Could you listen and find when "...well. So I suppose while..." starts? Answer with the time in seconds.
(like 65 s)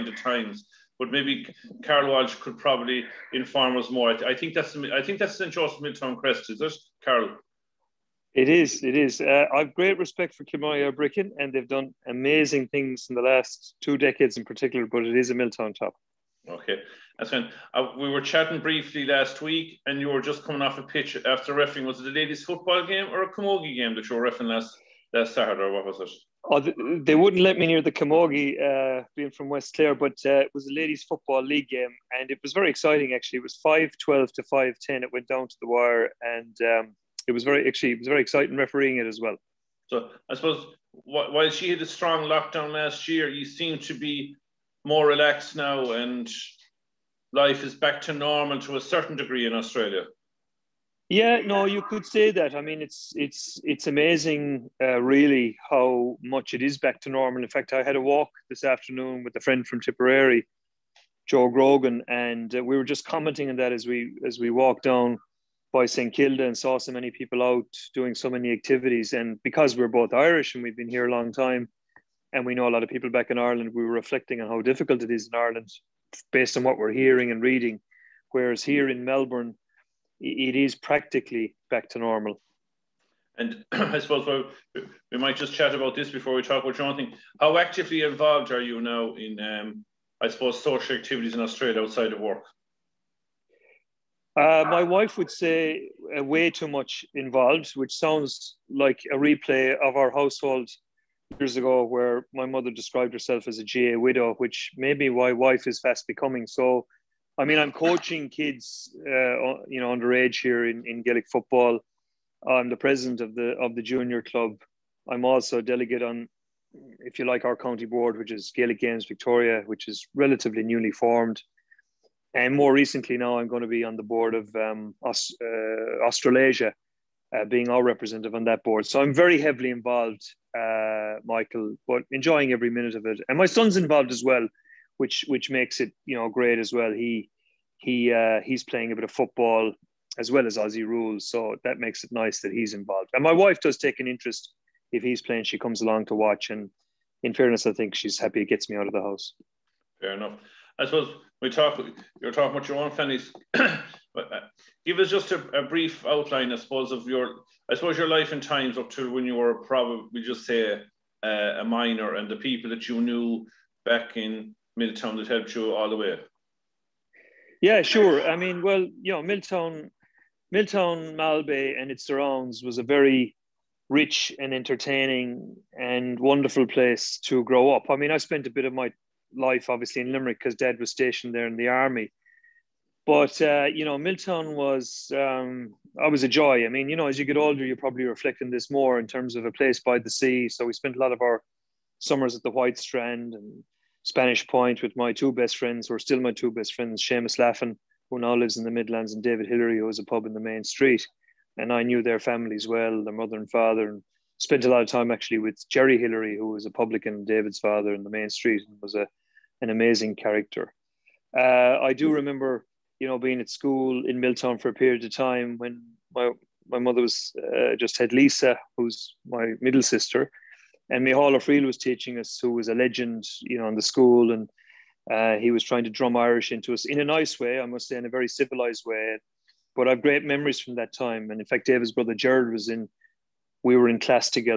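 39 s.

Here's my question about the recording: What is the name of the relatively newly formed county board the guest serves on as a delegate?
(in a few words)
Gaelic Games Victoria.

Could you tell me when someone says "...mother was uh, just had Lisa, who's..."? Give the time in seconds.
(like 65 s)
216 s.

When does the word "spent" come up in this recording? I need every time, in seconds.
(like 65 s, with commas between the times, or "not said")
178 s, 190 s, 204 s.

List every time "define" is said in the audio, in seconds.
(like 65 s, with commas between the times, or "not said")
not said.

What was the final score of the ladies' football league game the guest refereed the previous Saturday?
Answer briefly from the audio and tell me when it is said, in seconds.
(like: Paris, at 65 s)
5-12 to 5-10, at 33 s.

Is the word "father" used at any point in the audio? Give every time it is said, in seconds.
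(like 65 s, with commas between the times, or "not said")
203 s, 207 s.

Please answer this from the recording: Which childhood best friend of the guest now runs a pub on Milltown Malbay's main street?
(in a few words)
David Hillary.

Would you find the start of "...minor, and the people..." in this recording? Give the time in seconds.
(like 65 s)
161 s.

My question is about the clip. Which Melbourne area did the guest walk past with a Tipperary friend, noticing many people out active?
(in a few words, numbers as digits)
St Kilda.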